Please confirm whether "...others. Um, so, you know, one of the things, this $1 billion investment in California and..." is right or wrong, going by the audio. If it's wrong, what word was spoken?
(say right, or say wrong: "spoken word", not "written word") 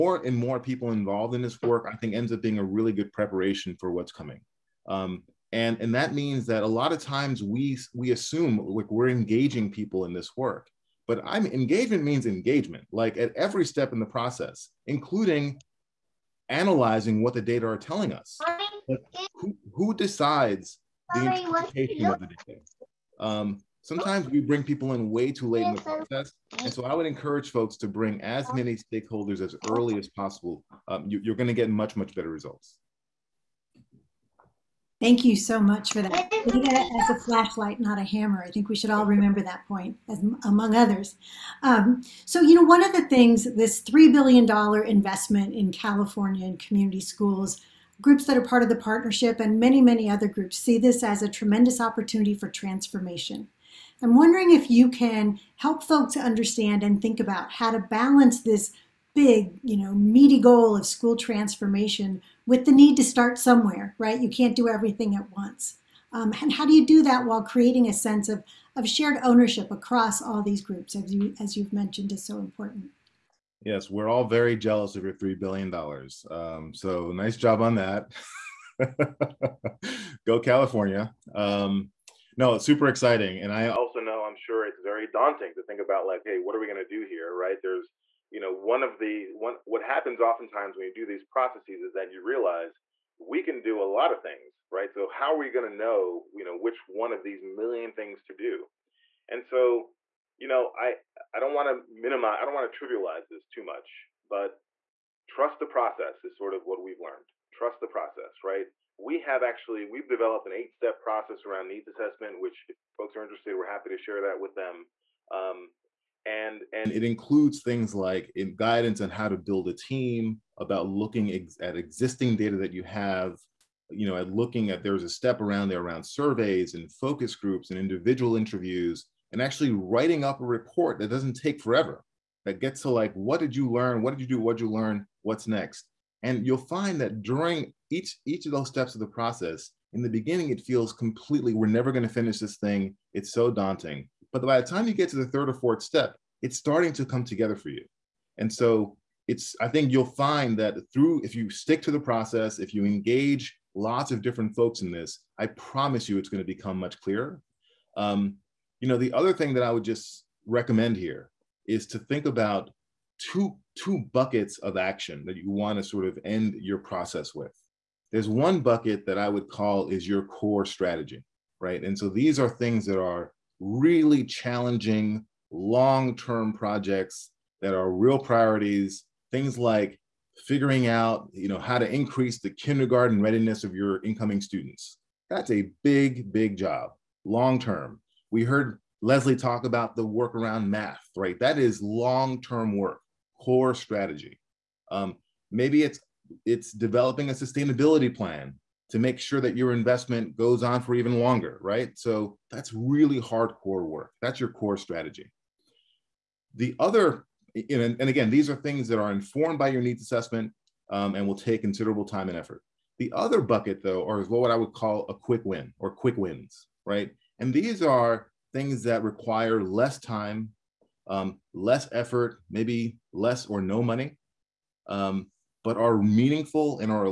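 wrong: "3", not "1".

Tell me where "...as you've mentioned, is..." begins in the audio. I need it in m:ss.
1:11.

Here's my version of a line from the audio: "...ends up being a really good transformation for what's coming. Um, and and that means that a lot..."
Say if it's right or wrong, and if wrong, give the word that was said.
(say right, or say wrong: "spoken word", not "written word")
wrong: "preparation", not "transformation".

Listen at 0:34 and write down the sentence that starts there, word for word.
Thank you so much for that.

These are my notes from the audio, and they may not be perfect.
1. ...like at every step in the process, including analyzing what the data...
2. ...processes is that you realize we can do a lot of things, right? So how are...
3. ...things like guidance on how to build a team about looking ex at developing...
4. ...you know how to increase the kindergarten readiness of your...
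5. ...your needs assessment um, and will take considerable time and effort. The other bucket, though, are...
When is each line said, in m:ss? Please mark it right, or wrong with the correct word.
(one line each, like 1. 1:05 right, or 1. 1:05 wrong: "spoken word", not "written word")
1. 0:12 right
2. 1:31 right
3. 1:57 wrong: "existing", not "developing"
4. 3:01 right
5. 3:29 right.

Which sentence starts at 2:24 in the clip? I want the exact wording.
But by the time you get to the third or fourth step, it's starting to come together for you.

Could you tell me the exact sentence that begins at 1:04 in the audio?
You can't do everything at once.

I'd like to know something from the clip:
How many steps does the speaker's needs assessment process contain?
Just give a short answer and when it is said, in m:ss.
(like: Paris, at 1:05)
8, at 1:50.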